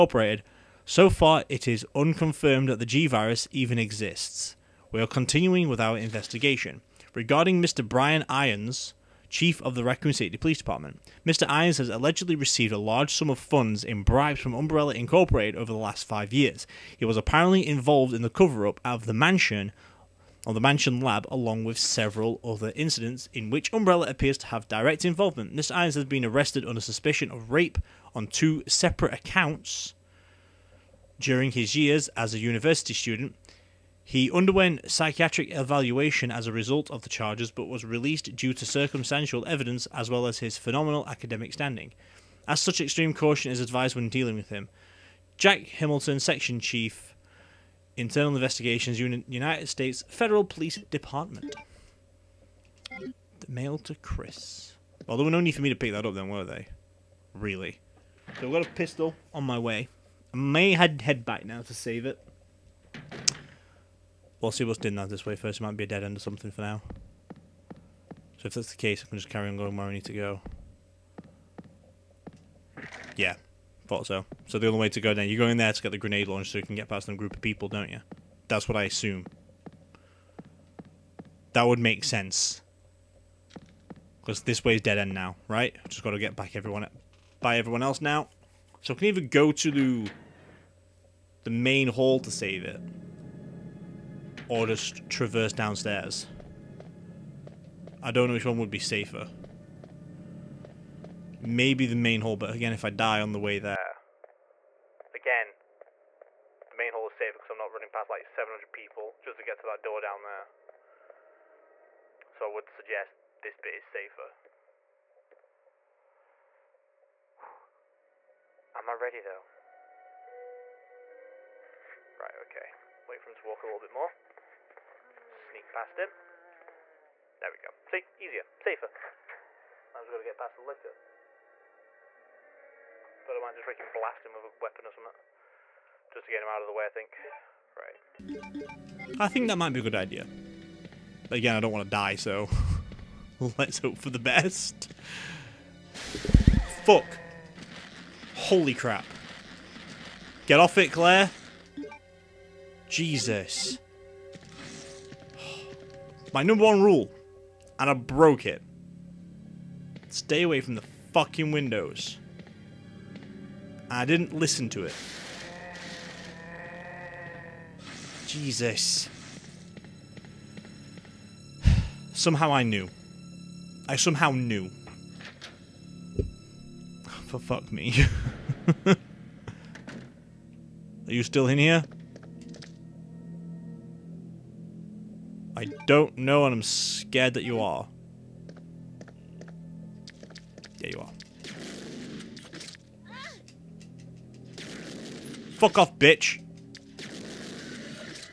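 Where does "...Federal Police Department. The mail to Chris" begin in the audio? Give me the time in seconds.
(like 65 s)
50 s.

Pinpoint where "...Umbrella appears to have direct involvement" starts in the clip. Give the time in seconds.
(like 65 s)
23 s.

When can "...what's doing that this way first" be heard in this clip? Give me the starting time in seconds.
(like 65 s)
64 s.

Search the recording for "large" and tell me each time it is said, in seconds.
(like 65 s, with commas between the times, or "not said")
12 s.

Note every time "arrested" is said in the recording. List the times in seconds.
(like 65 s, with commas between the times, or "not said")
26 s.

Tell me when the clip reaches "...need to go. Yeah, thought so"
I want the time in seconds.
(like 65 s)
69 s.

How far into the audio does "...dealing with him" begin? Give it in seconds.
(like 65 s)
44 s.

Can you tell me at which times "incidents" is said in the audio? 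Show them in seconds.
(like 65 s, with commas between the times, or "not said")
22 s.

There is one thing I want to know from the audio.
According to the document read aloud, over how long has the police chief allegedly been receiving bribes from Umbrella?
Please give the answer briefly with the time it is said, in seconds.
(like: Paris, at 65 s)
5 years, at 16 s.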